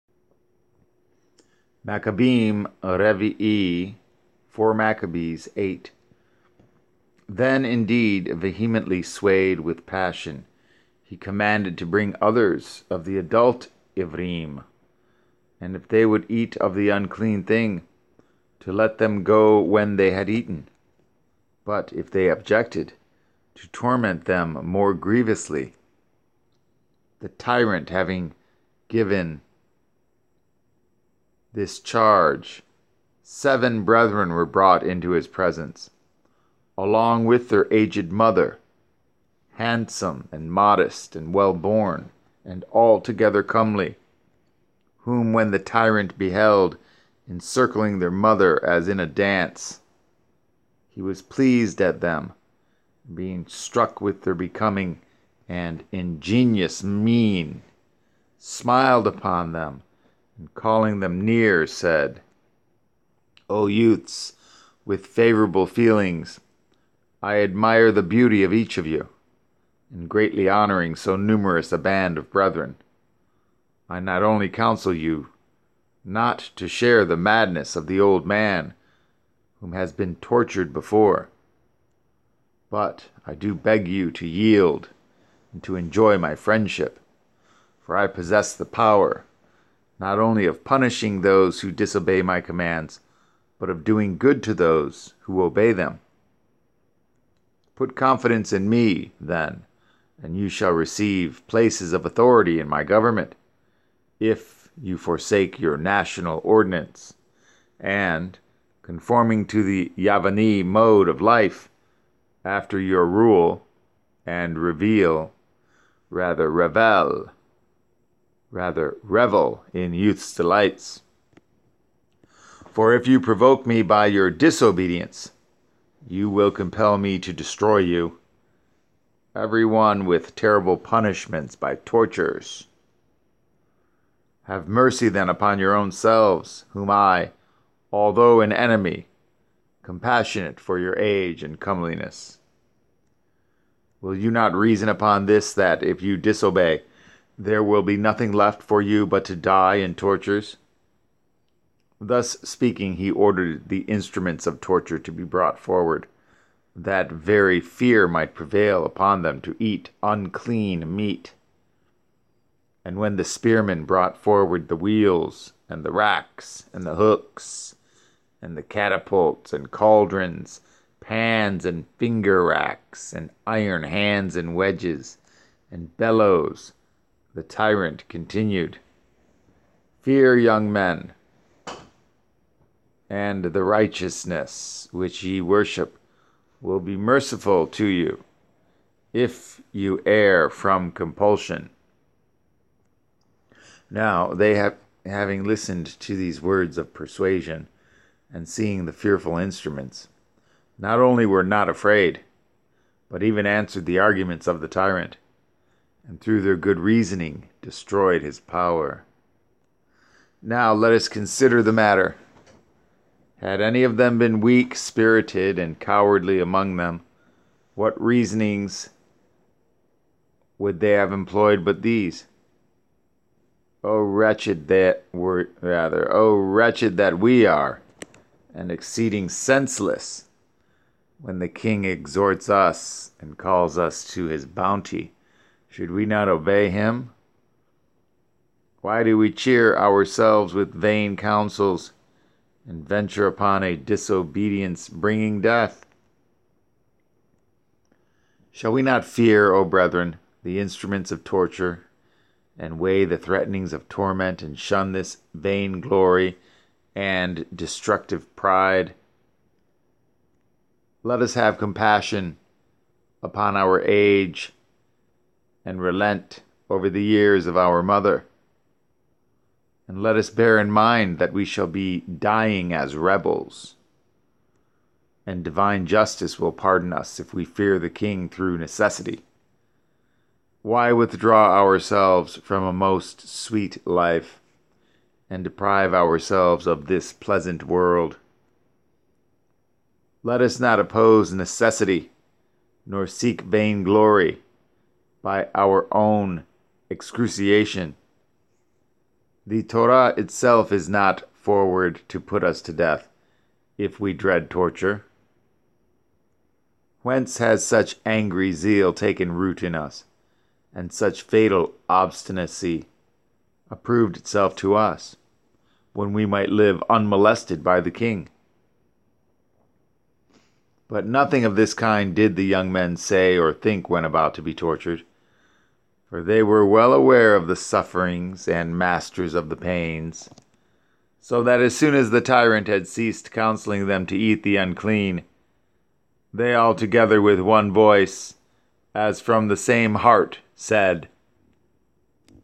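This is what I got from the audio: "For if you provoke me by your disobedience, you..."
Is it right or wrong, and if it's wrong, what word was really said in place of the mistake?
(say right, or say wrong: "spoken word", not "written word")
right.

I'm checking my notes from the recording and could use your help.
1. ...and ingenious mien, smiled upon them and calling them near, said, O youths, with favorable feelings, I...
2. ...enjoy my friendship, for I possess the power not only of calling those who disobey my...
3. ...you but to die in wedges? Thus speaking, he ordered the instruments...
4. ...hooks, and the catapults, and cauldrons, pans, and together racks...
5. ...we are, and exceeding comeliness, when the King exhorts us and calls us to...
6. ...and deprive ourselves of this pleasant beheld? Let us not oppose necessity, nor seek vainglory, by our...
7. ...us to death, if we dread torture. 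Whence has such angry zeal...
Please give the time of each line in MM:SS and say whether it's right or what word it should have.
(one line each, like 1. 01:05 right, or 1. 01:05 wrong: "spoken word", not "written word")
1. 00:55 right
2. 01:25 wrong: "punishing", not "calling"
3. 02:28 wrong: "tortures", not "wedges"
4. 02:46 wrong: "finger", not "together"
5. 03:47 wrong: "senseless", not "comeliness"
6. 04:45 wrong: "world", not "beheld"
7. 05:02 right.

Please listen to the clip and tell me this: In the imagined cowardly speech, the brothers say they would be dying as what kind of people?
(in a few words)
rebels.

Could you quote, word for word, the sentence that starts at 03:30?
Now let us consider the matter.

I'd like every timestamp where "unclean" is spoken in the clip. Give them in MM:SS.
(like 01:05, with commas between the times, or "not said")
00:16, 02:40, 05:34.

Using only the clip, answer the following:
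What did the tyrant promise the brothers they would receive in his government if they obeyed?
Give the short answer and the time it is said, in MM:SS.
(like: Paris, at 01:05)
places of authority, at 01:41.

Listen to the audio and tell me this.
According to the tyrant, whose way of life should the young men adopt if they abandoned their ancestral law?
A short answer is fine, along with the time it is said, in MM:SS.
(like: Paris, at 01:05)
Yavani, at 01:49.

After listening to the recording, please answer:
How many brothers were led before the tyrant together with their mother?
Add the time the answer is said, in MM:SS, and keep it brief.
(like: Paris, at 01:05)
7, at 00:33.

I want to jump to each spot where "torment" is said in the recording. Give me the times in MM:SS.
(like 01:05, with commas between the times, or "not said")
00:23, 04:13.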